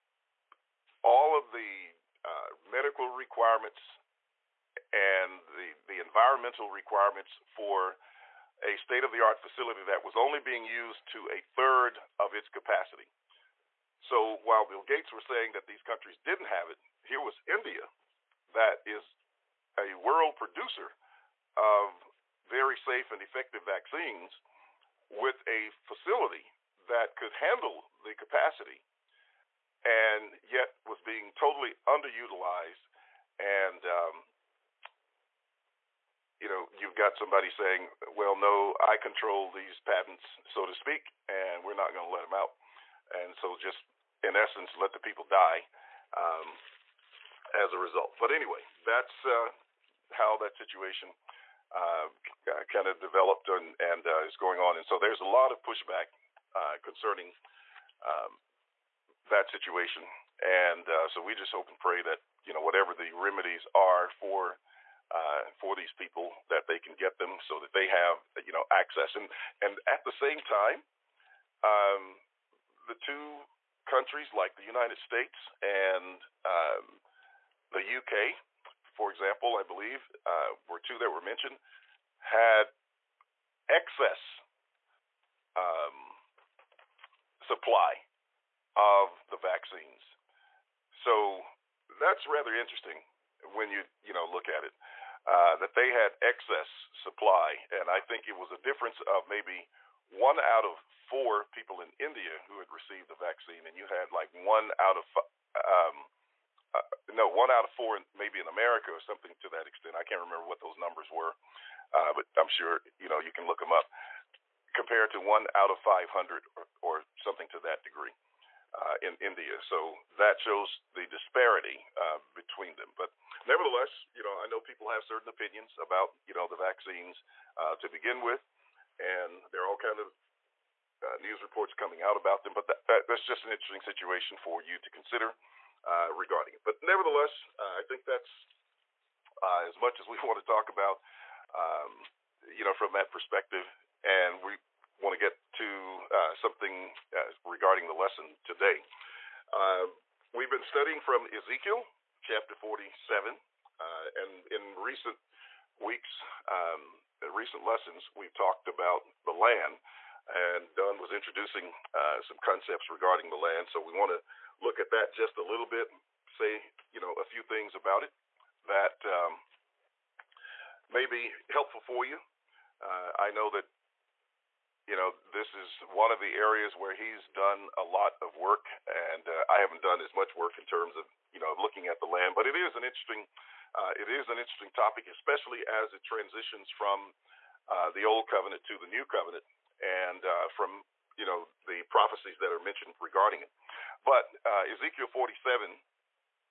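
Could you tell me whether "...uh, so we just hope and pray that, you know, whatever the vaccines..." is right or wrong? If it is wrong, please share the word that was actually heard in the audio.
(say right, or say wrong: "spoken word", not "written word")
wrong: "remedies", not "vaccines".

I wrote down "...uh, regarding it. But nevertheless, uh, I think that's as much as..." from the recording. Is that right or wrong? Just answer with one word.
right.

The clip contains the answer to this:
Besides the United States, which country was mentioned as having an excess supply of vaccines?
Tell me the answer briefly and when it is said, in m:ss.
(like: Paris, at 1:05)
UK, at 1:17.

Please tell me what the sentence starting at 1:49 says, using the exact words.
I can't remember what those numbers were, uh, but I'm sure you know you can look them up.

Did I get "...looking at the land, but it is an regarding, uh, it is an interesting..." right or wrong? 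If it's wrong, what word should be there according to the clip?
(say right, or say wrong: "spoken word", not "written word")
wrong: "interesting", not "regarding".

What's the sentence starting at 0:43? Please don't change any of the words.
And so just in essence, let the people die um, as a result.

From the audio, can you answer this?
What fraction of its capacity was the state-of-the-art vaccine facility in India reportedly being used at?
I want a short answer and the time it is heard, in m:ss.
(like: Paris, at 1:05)
a third, at 0:11.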